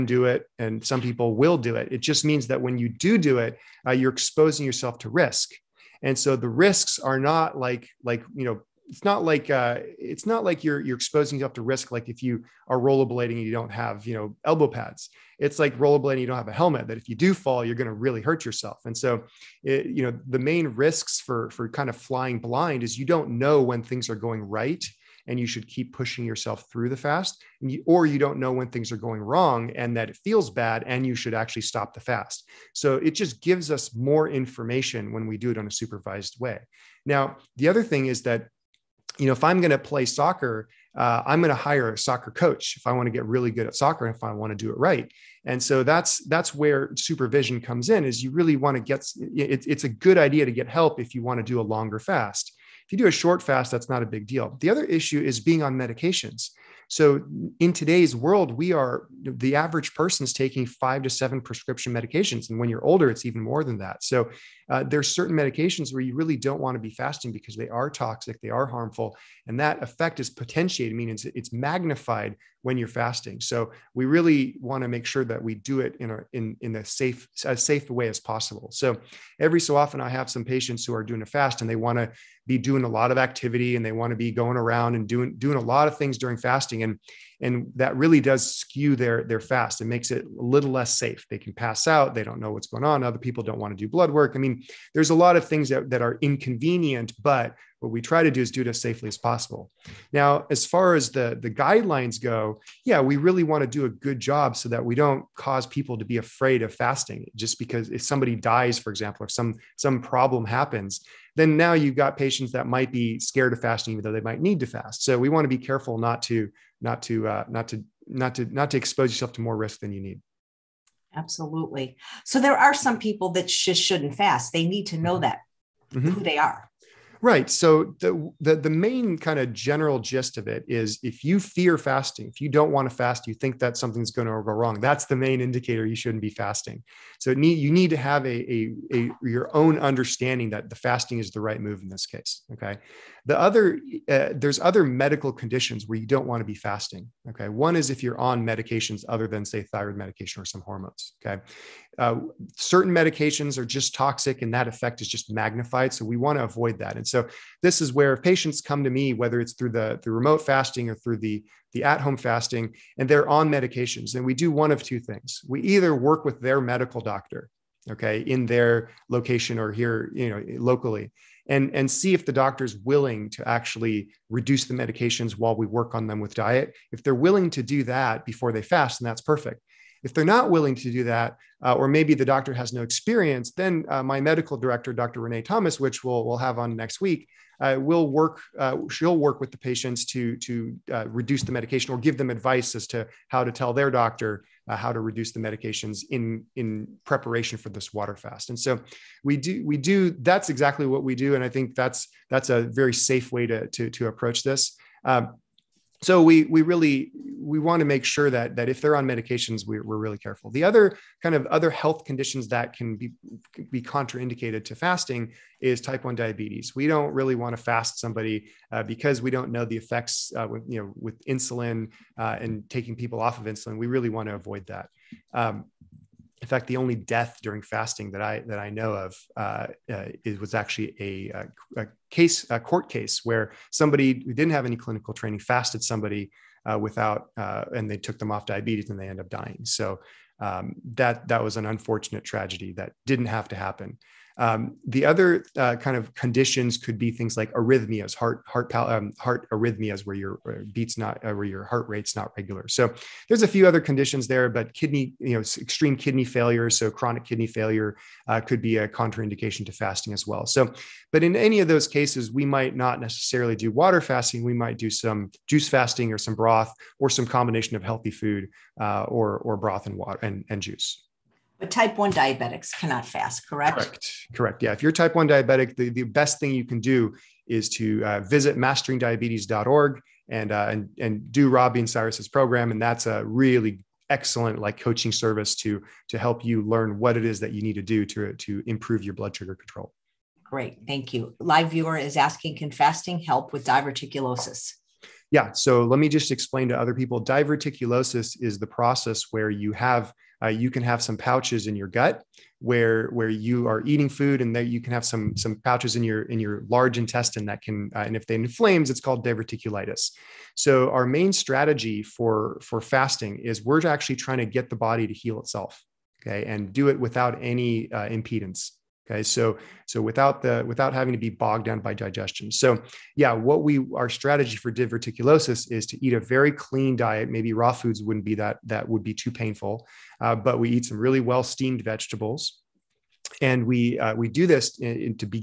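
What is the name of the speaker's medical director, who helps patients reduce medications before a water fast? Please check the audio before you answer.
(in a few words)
Dr. Renee Thomas.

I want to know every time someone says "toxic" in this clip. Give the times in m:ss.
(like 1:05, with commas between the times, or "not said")
1:07, 2:33.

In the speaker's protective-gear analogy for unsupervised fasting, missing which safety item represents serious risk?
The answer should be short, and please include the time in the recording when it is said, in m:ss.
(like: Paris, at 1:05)
helmet, at 0:16.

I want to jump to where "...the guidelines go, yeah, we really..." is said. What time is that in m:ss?
1:41.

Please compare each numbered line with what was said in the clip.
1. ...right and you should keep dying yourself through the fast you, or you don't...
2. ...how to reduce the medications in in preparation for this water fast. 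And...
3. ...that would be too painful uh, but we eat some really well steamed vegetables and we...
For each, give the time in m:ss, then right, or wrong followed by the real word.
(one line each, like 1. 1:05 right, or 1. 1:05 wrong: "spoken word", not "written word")
1. 0:24 wrong: "pushing", not "dying"
2. 3:14 right
3. 5:28 right.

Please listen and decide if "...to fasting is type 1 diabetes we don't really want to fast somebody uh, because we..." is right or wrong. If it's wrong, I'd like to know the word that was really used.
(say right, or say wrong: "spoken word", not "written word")
right.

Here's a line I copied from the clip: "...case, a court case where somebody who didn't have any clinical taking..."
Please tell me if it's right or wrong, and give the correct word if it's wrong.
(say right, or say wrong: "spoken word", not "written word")
wrong: "training", not "taking".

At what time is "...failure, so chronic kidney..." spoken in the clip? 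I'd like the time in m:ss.
4:16.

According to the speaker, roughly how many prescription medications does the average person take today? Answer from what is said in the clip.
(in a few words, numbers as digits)
5 to 7.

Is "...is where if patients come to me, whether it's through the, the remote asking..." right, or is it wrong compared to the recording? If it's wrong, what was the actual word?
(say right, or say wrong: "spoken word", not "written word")
wrong: "fasting", not "asking".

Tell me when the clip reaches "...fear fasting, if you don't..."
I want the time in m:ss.
2:11.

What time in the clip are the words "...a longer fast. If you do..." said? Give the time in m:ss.
0:51.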